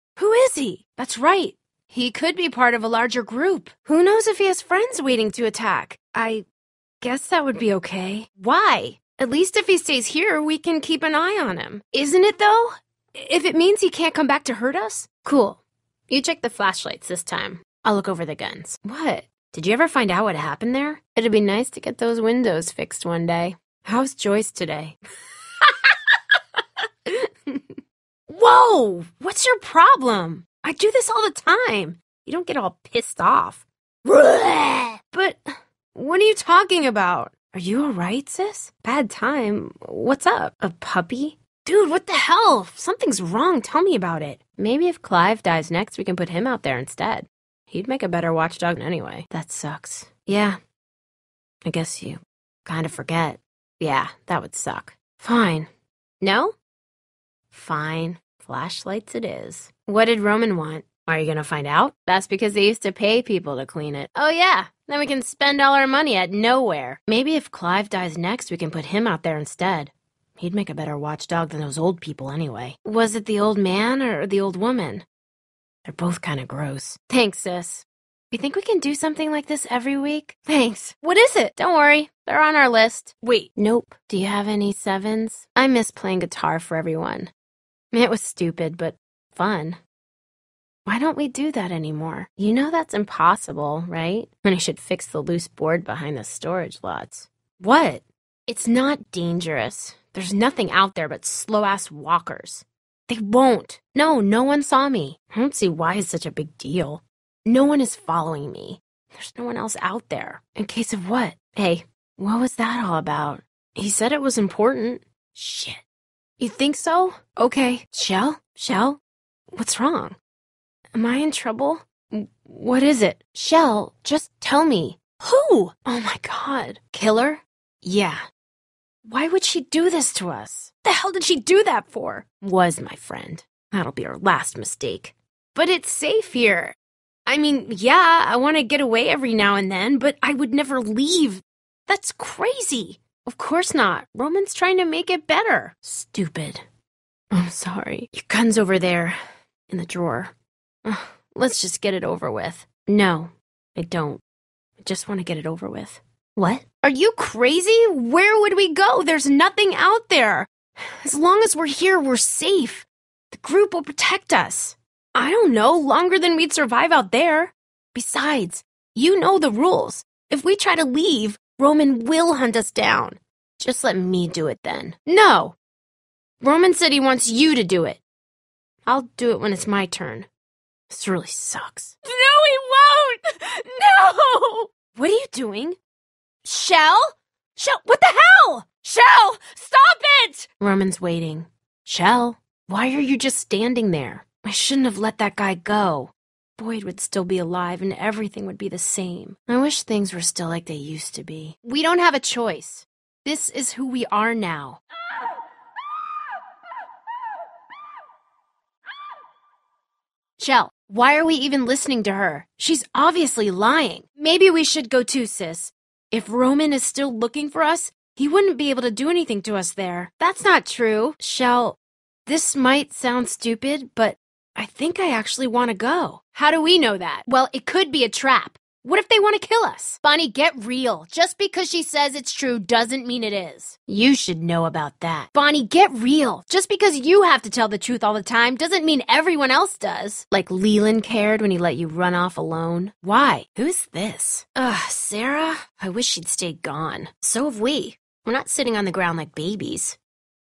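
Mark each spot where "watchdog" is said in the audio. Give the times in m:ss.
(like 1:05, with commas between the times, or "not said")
0:48, 1:10.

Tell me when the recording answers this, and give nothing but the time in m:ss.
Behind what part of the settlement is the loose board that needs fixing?
1:36.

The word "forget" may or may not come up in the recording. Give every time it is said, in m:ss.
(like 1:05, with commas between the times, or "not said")
0:52.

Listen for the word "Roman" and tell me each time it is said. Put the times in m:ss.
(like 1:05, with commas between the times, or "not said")
1:00, 2:24, 2:51, 2:56, 3:10, 3:36.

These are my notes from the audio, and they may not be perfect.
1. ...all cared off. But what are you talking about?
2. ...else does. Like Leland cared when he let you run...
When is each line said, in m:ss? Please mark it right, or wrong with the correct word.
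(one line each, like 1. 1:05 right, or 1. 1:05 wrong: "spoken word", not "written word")
1. 0:32 wrong: "pissed", not "cared"
2. 3:59 right.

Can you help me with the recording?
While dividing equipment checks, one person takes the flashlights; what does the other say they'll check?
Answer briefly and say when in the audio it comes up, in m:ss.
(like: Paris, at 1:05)
The guns, at 0:18.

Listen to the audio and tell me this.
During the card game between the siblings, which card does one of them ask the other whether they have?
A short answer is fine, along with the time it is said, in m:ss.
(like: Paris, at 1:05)
Sevens, at 1:24.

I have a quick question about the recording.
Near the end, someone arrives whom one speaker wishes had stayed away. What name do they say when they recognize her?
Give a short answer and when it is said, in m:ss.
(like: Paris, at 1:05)
Sarah, at 4:04.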